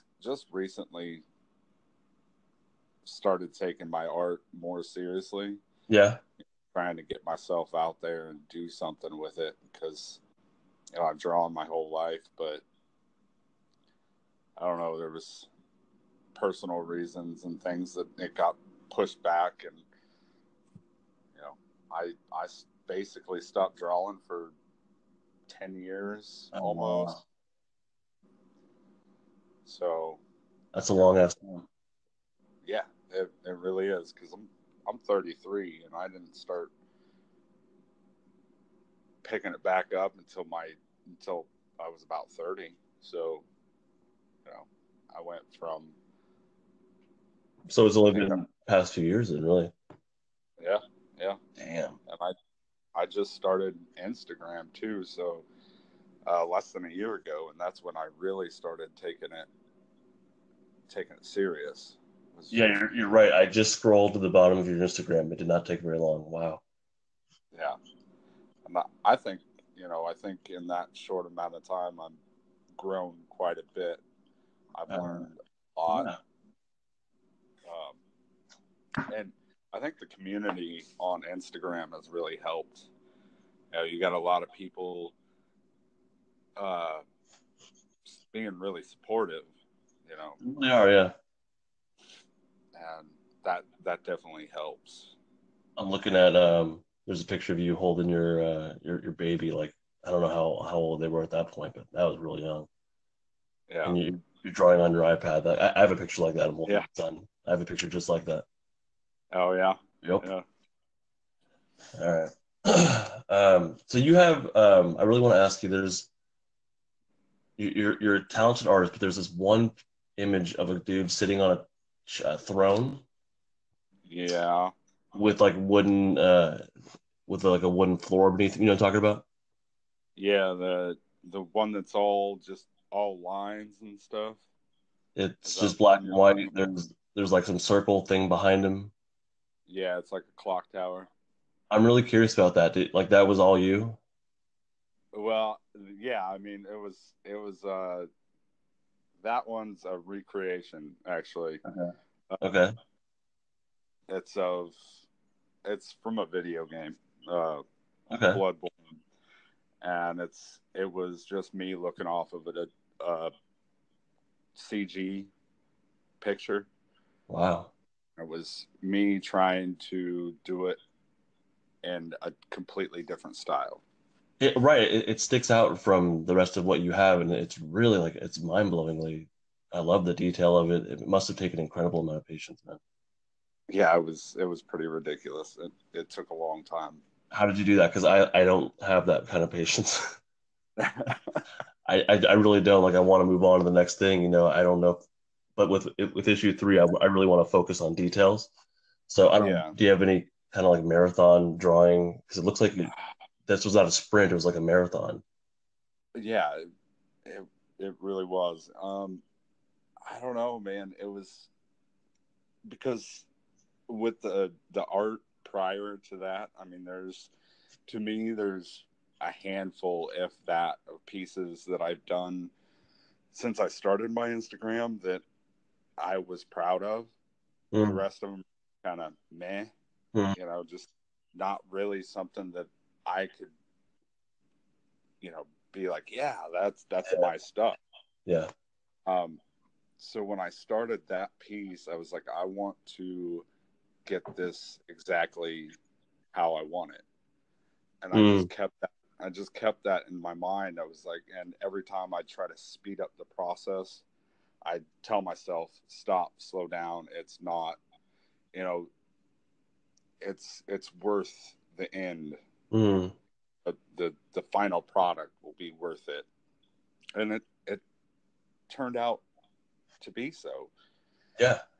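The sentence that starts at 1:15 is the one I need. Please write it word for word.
learned a lot yeah and I think the community on Instagram has really helped.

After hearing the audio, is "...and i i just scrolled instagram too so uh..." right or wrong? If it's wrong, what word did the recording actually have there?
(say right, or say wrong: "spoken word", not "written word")
wrong: "started", not "scrolled".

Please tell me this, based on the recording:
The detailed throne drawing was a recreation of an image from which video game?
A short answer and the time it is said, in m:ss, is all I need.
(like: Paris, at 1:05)
Bloodborne, at 2:38.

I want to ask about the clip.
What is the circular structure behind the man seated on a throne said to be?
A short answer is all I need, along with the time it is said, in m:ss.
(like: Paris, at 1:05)
A clock tower, at 2:20.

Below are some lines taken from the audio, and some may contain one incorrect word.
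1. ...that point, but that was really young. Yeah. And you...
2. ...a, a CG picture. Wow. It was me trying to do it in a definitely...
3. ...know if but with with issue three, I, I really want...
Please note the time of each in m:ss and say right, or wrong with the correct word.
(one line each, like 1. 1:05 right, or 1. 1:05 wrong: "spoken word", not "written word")
1. 1:41 right
2. 2:42 wrong: "completely", not "definitely"
3. 3:14 right.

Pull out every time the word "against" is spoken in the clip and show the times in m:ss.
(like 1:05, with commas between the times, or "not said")
not said.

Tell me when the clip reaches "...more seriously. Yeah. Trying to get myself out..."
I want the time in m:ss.
0:04.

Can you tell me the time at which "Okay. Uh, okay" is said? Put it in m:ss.
2:31.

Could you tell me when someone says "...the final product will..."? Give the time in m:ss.
4:24.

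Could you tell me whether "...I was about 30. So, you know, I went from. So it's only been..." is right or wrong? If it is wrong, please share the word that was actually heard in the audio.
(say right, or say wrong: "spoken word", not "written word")
right.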